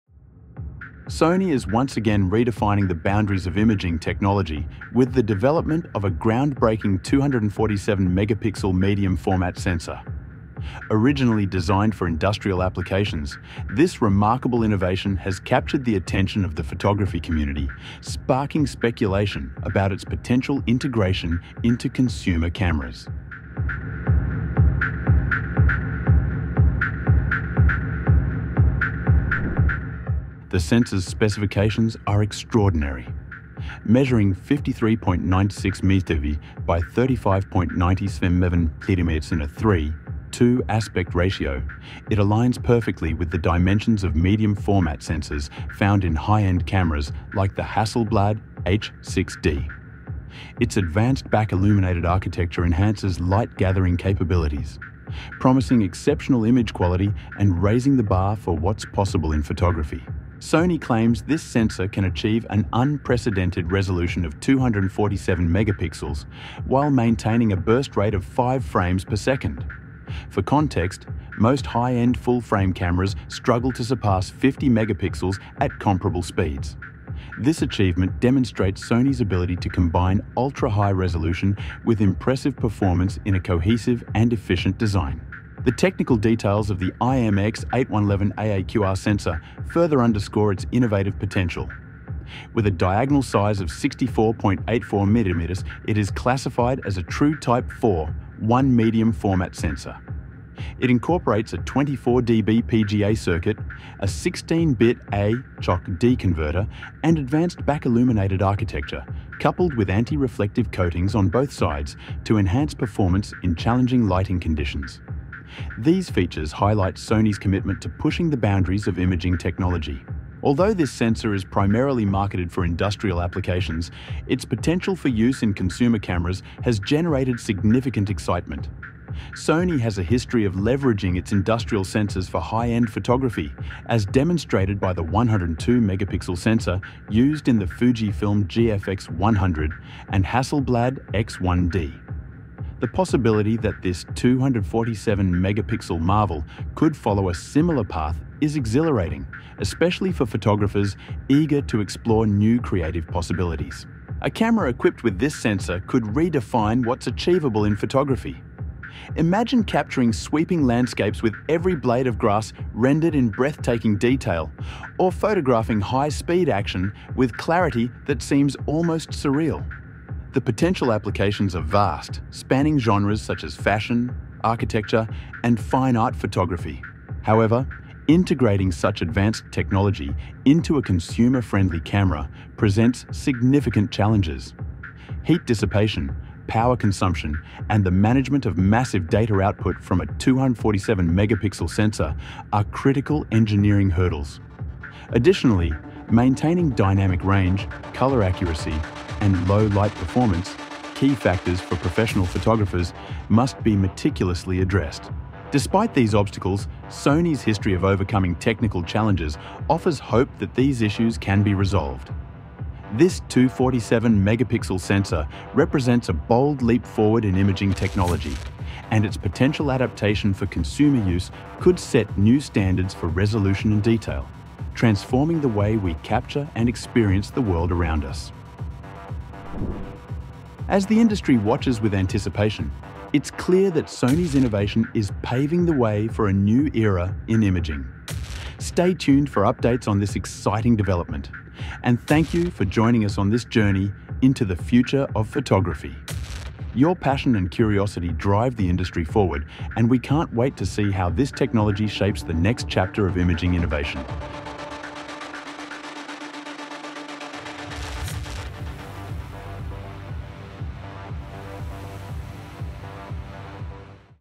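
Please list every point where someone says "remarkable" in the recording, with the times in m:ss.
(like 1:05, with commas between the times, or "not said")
0:14.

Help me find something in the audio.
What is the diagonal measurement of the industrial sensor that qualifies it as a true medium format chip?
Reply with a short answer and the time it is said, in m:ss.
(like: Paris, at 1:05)
64.84 millimeters, at 1:33.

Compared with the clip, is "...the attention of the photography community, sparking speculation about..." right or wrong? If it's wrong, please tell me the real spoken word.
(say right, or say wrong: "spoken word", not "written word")
right.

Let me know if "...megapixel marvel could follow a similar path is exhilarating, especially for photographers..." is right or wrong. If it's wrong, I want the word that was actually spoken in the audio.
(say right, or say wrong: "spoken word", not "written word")
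right.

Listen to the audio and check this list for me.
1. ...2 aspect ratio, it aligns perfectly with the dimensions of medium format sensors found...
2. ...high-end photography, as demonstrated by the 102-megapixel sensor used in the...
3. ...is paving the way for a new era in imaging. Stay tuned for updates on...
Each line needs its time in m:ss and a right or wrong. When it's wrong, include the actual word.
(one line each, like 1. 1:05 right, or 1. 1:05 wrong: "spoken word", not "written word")
1. 0:40 right
2. 2:12 right
3. 3:54 right.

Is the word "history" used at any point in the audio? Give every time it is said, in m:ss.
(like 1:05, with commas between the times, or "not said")
2:10, 3:27.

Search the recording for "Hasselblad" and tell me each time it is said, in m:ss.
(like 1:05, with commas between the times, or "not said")
0:47, 2:20.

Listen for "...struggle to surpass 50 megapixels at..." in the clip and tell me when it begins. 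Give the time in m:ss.
1:13.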